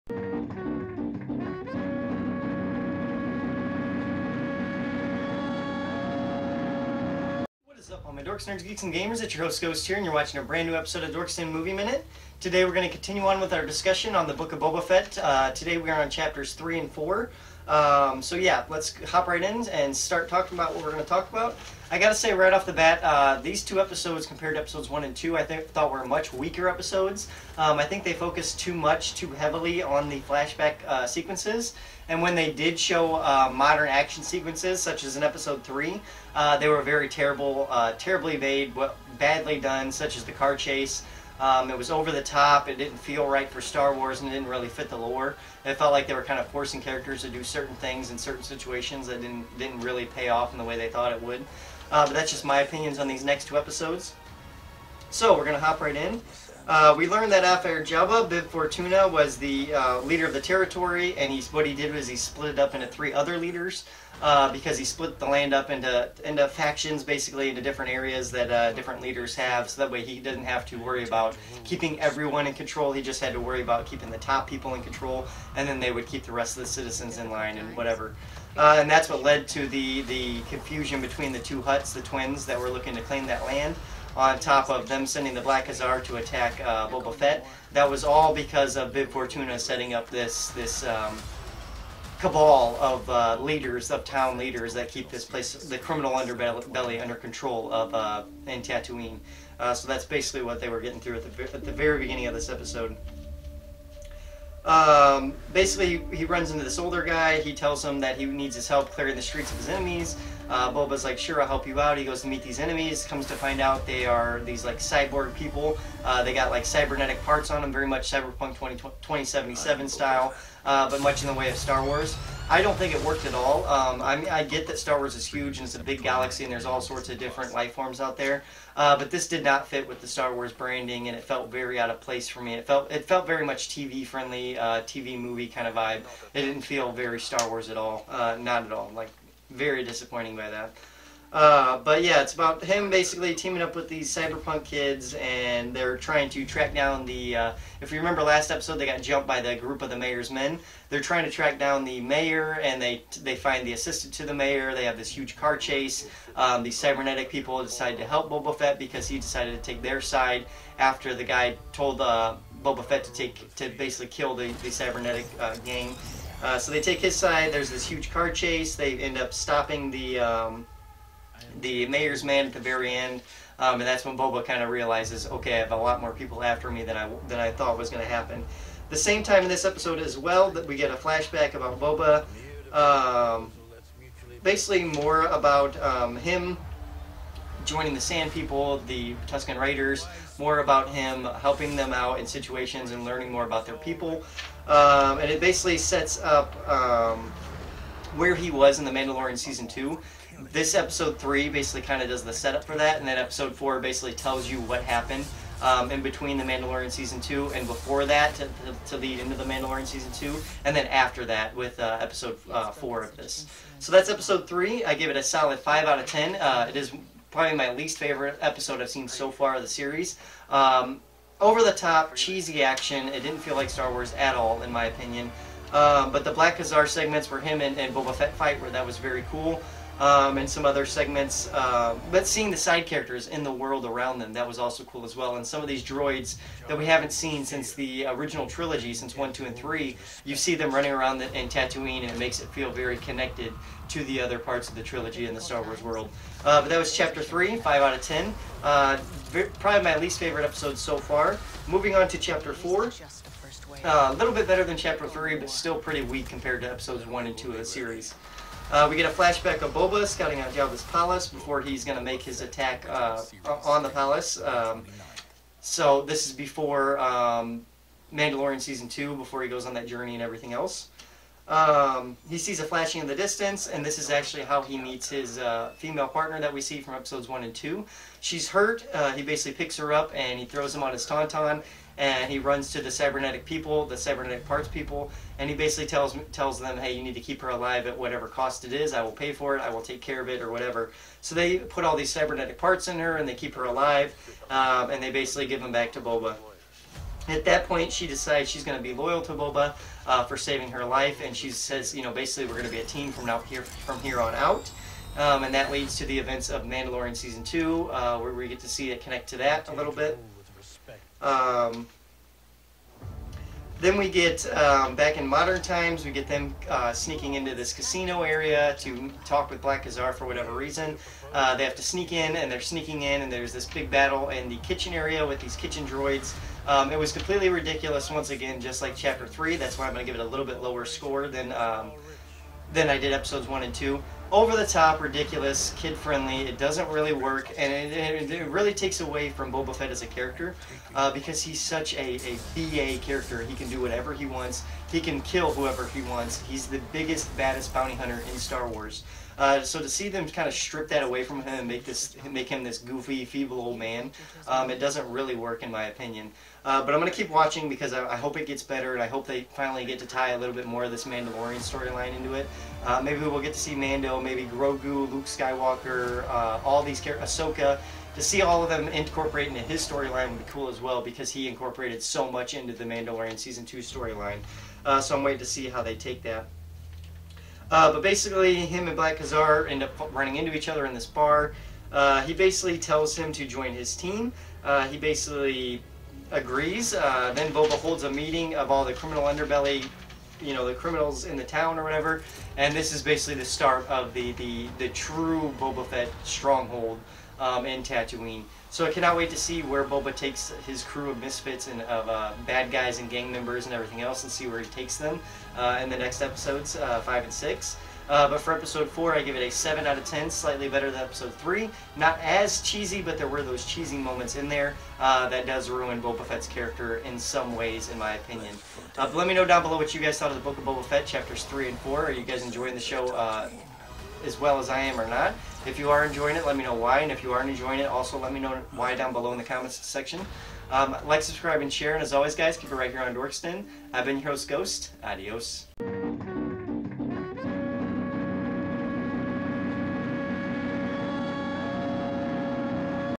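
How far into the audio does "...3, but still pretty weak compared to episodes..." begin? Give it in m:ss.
4:15.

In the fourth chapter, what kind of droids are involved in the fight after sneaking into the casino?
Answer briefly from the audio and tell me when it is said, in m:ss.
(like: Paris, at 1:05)
Kitchen droids, at 5:25.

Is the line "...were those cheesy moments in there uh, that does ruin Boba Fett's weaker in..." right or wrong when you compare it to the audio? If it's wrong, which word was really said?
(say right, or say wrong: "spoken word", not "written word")
wrong: "character", not "weaker".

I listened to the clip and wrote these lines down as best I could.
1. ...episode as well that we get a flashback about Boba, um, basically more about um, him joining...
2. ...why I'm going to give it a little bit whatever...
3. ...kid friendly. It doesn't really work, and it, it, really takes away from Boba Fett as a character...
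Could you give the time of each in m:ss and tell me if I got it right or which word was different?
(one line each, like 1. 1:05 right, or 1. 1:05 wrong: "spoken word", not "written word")
1. 2:59 right
2. 5:29 wrong: "lower", not "whatever"
3. 5:35 right.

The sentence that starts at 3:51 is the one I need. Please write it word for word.
Uh, but seeing the side characters in the world around them, that was also cool as well.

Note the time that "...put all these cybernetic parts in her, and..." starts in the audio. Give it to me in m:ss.
4:51.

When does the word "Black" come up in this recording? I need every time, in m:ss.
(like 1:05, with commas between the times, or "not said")
1:25, 3:46, 5:19, 6:18.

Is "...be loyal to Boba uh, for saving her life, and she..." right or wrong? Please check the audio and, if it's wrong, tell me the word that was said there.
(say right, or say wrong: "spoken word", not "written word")
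right.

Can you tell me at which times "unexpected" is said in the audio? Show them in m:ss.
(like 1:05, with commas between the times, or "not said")
not said.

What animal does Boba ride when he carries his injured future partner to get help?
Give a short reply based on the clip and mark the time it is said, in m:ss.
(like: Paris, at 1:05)
Tauntaun, at 4:41.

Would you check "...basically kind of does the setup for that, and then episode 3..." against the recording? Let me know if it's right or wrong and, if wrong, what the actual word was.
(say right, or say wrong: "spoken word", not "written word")
wrong: "4", not "3".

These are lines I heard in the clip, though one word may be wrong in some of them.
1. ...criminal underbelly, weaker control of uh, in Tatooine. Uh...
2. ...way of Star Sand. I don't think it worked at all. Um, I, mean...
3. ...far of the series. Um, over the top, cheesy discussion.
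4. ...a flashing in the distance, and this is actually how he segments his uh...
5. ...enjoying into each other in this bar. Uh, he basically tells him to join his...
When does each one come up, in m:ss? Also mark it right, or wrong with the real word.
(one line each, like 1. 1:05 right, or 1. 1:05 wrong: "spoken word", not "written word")
1. 1:35 wrong: "under", not "weaker"
2. 2:01 wrong: "Wars", not "Sand"
3. 3:39 wrong: "action", not "discussion"
4. 4:32 wrong: "meets", not "segments"
5. 6:20 wrong: "running", not "enjoying".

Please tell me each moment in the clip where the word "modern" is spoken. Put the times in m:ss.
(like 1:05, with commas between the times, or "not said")
0:33, 5:15.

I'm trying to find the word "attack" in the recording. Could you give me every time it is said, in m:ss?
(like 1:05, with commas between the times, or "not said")
1:26, 4:22.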